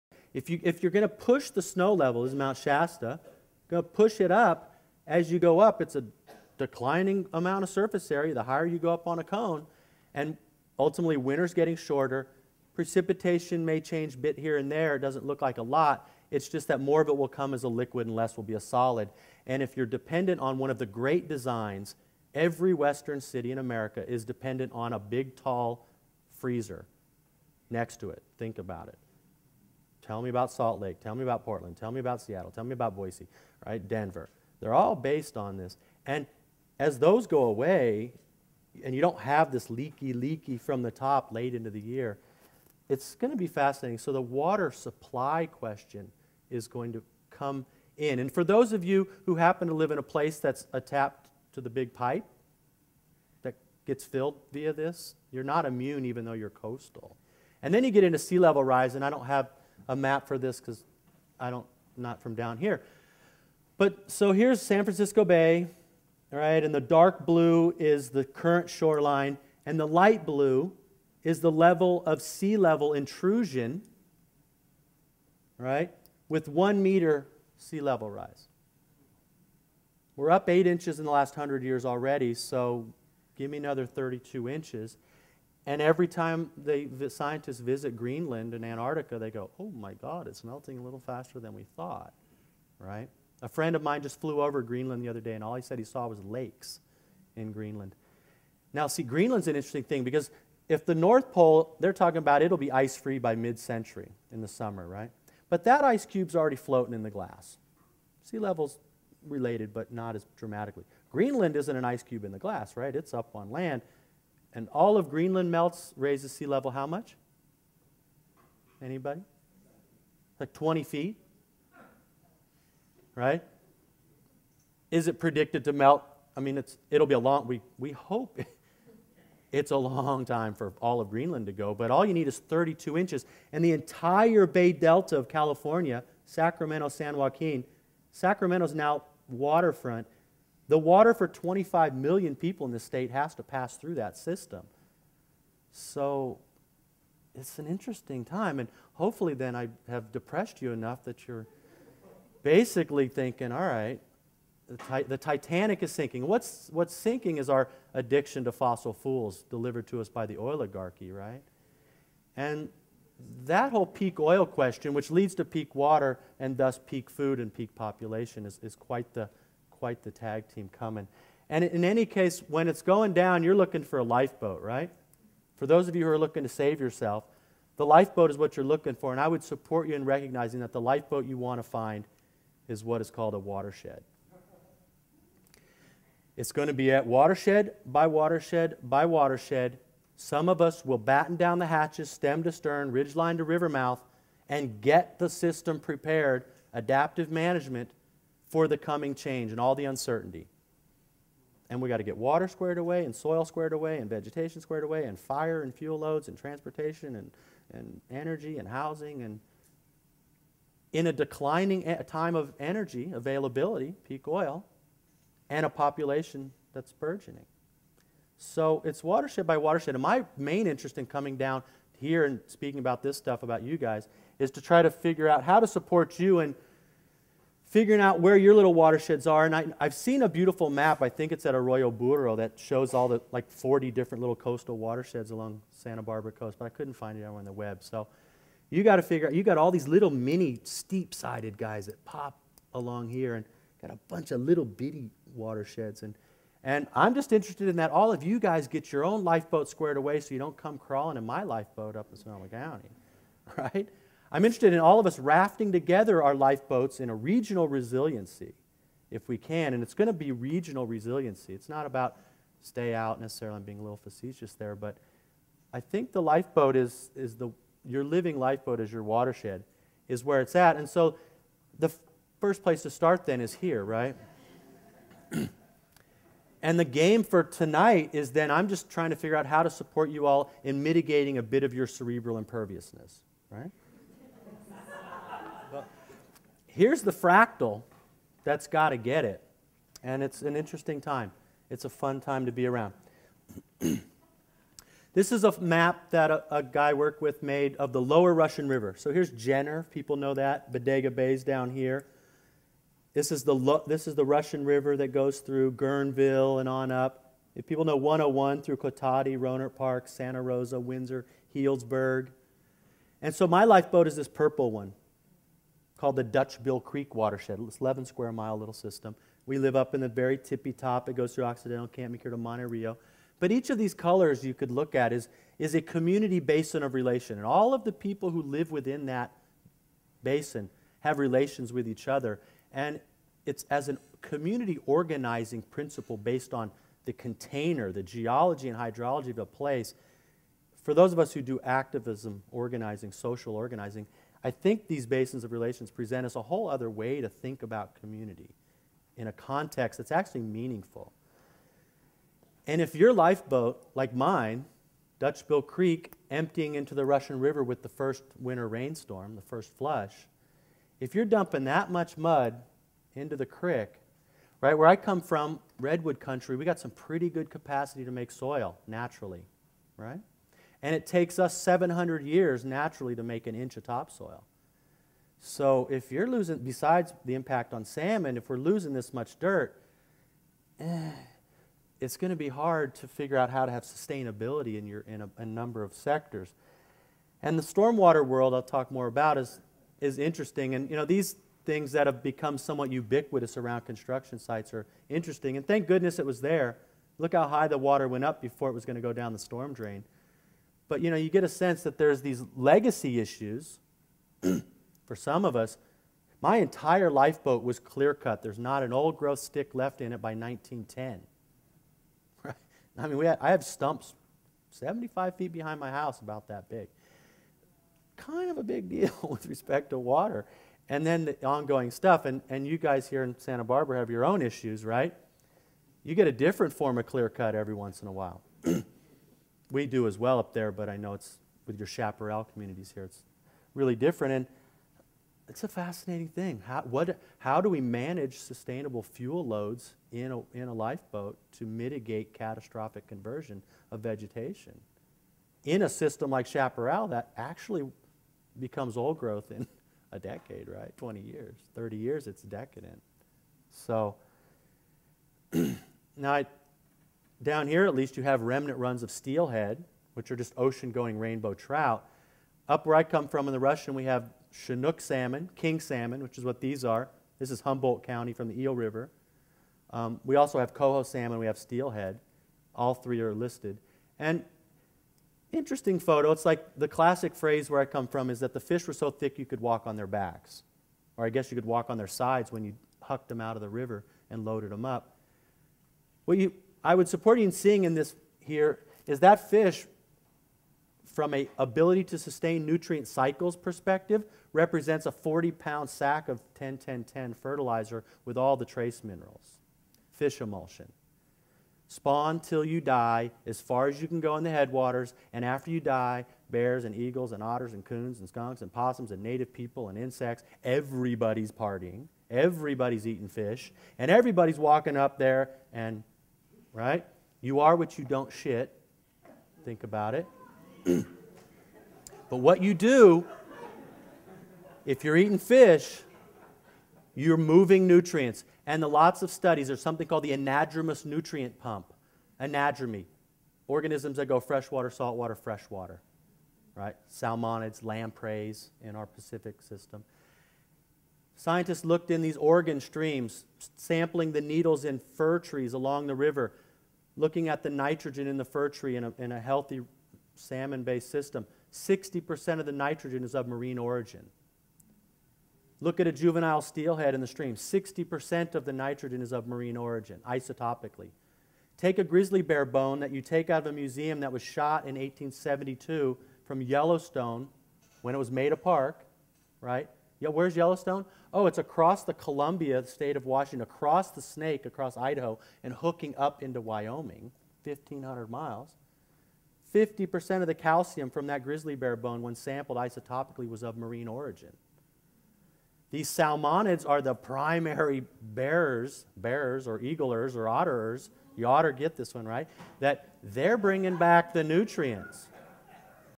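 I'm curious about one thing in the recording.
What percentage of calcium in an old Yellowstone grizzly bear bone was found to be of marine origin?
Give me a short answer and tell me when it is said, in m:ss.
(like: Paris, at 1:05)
50%, at 9:39.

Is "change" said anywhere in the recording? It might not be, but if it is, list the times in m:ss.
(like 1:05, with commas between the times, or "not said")
0:13, 3:19.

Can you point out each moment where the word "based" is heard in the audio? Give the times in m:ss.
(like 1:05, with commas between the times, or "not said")
0:34, 5:36, 9:10.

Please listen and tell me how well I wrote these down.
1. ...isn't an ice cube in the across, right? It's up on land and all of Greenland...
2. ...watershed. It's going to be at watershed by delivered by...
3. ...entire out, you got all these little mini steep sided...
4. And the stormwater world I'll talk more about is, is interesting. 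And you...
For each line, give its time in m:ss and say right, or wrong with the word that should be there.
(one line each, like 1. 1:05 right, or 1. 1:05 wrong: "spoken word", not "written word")
1. 1:51 wrong: "glass", not "across"
2. 3:03 wrong: "watershed", not "delivered"
3. 3:59 wrong: "figure", not "entire"
4. 6:27 right.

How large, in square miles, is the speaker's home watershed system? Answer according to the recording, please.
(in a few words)
11 square miles.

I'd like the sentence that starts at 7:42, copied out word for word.
Up where I come from in the Russian, we have Chinook salmon, king salmon, which is what these are.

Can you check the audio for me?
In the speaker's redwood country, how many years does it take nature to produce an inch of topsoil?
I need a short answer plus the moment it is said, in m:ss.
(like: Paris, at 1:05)
700 years, at 6:11.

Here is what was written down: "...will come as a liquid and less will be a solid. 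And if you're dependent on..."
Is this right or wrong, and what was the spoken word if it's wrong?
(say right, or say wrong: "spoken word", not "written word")
right.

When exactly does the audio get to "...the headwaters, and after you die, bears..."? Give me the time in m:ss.
8:24.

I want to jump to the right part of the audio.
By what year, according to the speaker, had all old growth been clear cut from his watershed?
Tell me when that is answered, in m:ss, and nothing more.
6:50.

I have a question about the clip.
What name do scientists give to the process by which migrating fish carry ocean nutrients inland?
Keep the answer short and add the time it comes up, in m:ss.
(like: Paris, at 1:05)
anadromous nutrient pump, at 8:50.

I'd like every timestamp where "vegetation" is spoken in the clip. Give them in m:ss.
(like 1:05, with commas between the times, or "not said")
3:24, 7:24.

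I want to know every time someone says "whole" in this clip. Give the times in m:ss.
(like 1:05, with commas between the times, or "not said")
2:43, 5:46.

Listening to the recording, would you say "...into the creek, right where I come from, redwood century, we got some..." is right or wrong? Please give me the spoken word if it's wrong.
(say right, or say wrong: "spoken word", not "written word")
wrong: "country", not "century".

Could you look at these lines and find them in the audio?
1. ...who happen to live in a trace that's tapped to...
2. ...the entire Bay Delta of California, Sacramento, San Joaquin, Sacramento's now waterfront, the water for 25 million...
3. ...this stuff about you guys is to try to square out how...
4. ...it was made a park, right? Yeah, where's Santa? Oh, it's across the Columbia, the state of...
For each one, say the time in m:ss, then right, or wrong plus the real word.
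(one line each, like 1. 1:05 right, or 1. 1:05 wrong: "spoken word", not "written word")
1. 0:49 wrong: "place", not "trace"
2. 2:13 right
3. 3:43 wrong: "figure", not "square"
4. 9:28 wrong: "Yellowstone", not "Santa".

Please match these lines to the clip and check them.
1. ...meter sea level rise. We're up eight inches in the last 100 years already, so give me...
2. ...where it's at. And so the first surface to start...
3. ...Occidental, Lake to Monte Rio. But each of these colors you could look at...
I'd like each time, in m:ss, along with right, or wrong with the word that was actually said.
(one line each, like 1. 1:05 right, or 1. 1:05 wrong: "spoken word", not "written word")
1. 1:16 right
2. 4:30 wrong: "place", not "surface"
3. 5:21 wrong: "Camp", not "Lake".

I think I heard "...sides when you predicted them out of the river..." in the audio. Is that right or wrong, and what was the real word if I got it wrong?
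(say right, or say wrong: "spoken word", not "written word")
wrong: "hucked", not "predicted".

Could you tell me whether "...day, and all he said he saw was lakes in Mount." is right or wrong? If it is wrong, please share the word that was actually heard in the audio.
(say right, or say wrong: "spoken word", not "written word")
wrong: "Greenland", not "Mount".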